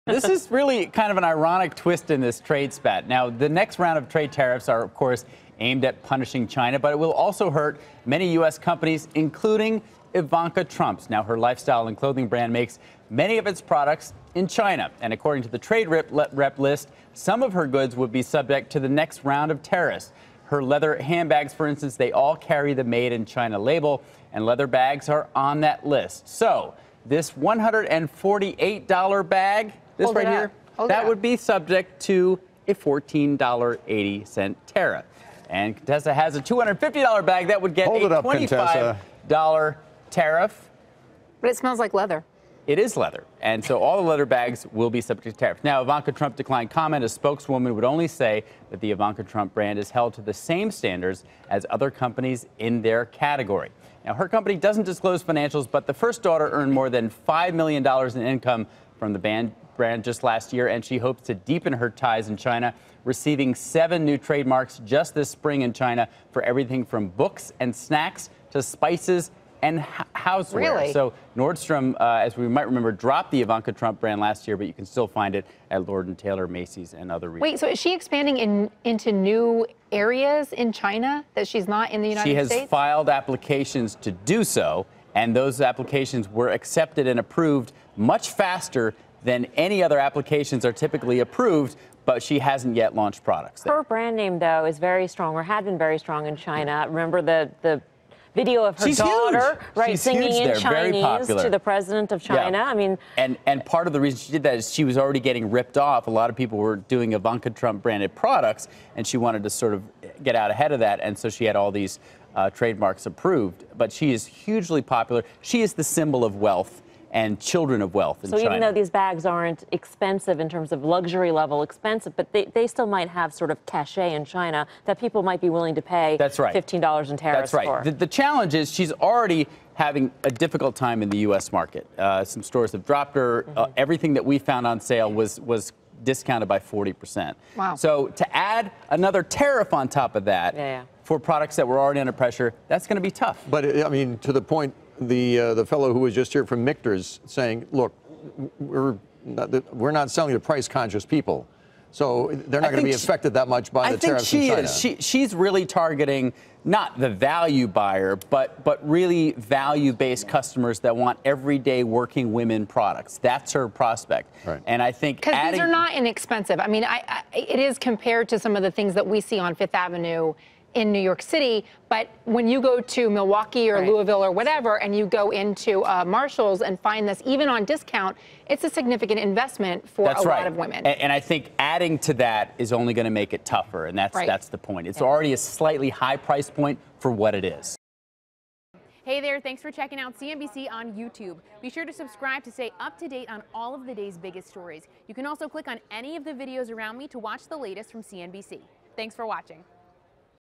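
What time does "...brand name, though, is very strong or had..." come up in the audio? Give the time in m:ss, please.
1:33.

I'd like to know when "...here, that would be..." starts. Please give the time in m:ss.
0:30.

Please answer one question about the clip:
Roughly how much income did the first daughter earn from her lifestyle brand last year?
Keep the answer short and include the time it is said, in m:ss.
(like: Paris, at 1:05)
More than $5 million, at 0:57.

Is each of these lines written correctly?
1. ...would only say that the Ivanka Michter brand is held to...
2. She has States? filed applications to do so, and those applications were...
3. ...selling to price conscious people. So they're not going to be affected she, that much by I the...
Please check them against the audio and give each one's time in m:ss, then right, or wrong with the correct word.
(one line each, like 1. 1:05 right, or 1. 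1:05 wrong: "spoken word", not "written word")
1. 0:47 wrong: "Trump", not "Michter"
2. 1:22 right
3. 2:30 right.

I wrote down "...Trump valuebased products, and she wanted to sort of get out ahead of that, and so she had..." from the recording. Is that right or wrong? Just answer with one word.
wrong.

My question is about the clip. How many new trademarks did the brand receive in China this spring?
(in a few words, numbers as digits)
7.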